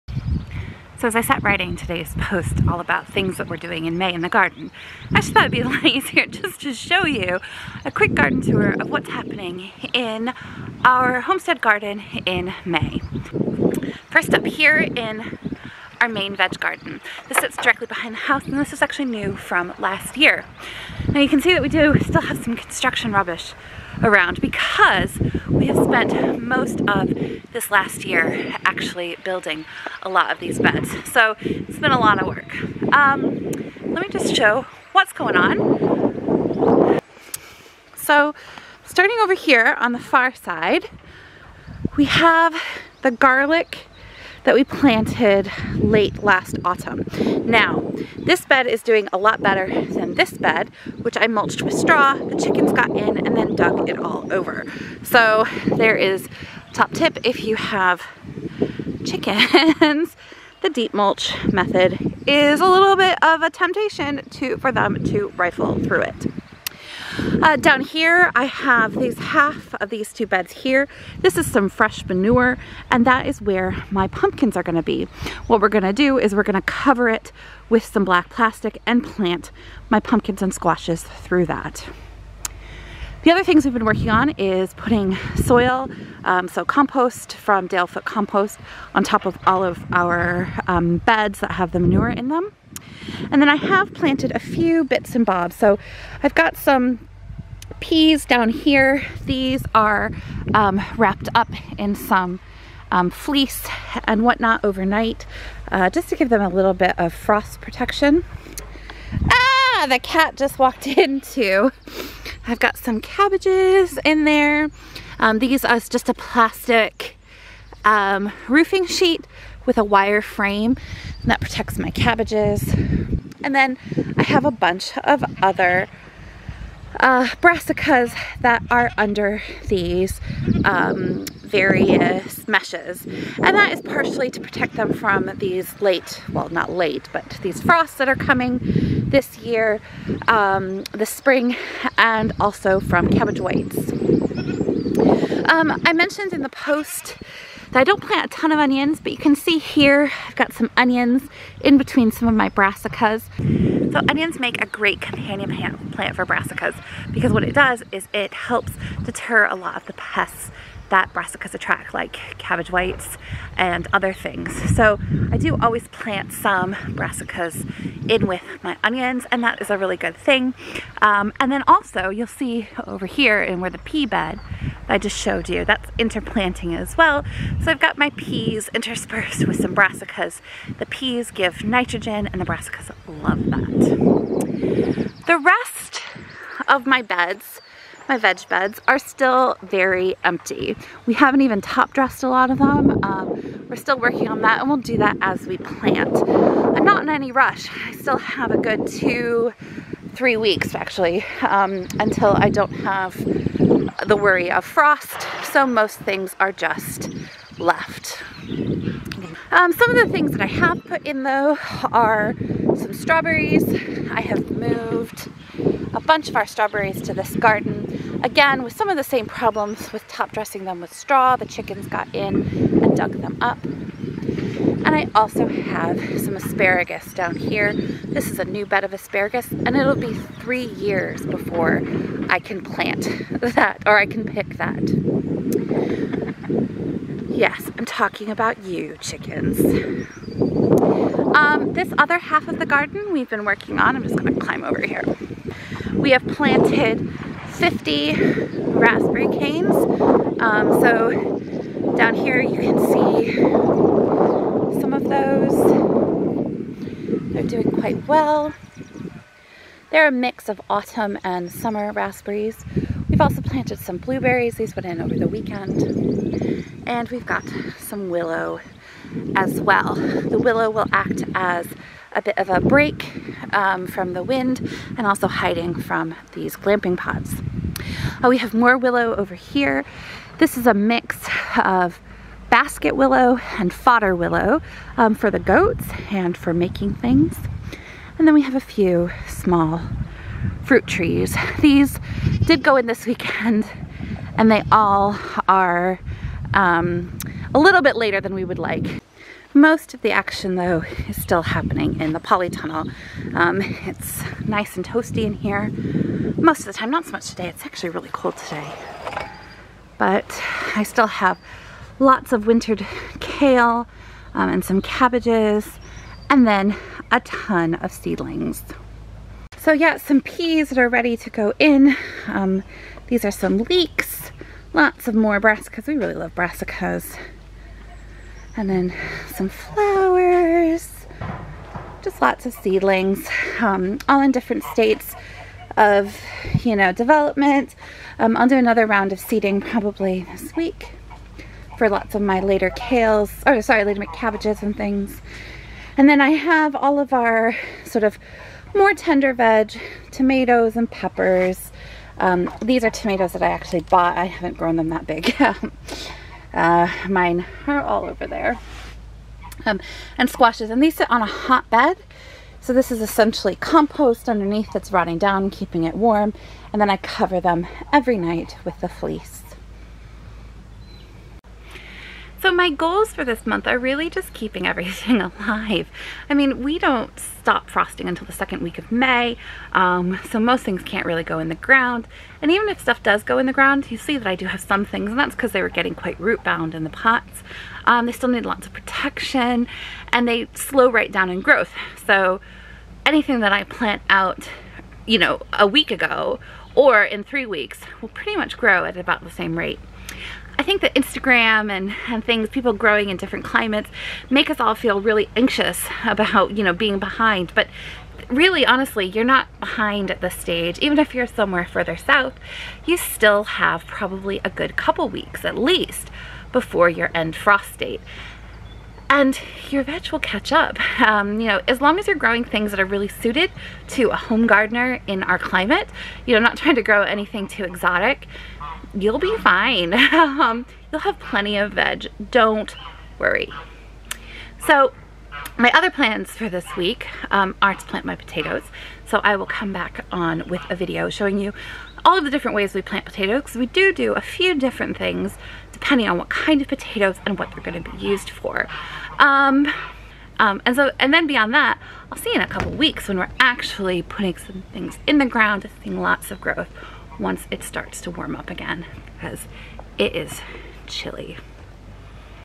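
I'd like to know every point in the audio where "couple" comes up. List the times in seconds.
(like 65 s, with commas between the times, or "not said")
414 s, 452 s.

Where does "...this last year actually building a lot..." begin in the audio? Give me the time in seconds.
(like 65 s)
27 s.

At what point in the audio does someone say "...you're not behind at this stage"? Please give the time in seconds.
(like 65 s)
409 s.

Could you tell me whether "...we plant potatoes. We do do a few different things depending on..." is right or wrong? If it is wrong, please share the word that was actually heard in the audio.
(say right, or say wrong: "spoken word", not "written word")
right.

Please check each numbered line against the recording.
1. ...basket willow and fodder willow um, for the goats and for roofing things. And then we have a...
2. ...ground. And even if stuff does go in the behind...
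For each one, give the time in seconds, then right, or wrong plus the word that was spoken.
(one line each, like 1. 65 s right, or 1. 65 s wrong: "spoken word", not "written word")
1. 282 s wrong: "making", not "roofing"
2. 381 s wrong: "ground", not "behind".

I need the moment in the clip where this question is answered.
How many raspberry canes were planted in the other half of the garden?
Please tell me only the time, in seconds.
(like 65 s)
247 s.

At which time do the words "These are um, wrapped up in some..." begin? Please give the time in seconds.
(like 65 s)
99 s.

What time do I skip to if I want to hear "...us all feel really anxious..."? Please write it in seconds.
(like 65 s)
404 s.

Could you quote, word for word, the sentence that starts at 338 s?
Um, I'll do another round of seeding probably this week for lots of my later kales, or sorry, later cabbages and things.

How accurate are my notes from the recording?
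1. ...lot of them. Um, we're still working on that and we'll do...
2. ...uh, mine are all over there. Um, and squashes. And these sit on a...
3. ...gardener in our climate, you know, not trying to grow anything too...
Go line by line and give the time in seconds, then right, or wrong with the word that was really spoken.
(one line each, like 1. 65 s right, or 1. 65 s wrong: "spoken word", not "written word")
1. 192 s right
2. 356 s right
3. 424 s right.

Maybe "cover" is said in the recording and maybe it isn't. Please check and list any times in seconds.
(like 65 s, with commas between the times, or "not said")
76 s, 366 s.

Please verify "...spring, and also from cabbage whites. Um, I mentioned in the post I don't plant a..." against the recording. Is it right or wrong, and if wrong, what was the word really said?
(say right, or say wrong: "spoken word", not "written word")
right.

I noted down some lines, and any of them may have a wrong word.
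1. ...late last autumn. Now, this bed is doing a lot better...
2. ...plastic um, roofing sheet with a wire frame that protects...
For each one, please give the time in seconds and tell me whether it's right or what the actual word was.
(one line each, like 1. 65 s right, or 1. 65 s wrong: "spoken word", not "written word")
1. 45 s right
2. 116 s right.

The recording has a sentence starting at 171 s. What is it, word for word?
Um, and then also you'll see over here in where the pea bed, I just showed you.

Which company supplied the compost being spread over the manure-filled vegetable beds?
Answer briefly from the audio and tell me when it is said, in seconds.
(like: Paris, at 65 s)
Dalefoot Compost, at 87 s.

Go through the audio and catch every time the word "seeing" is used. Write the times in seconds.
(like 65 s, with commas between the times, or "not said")
455 s.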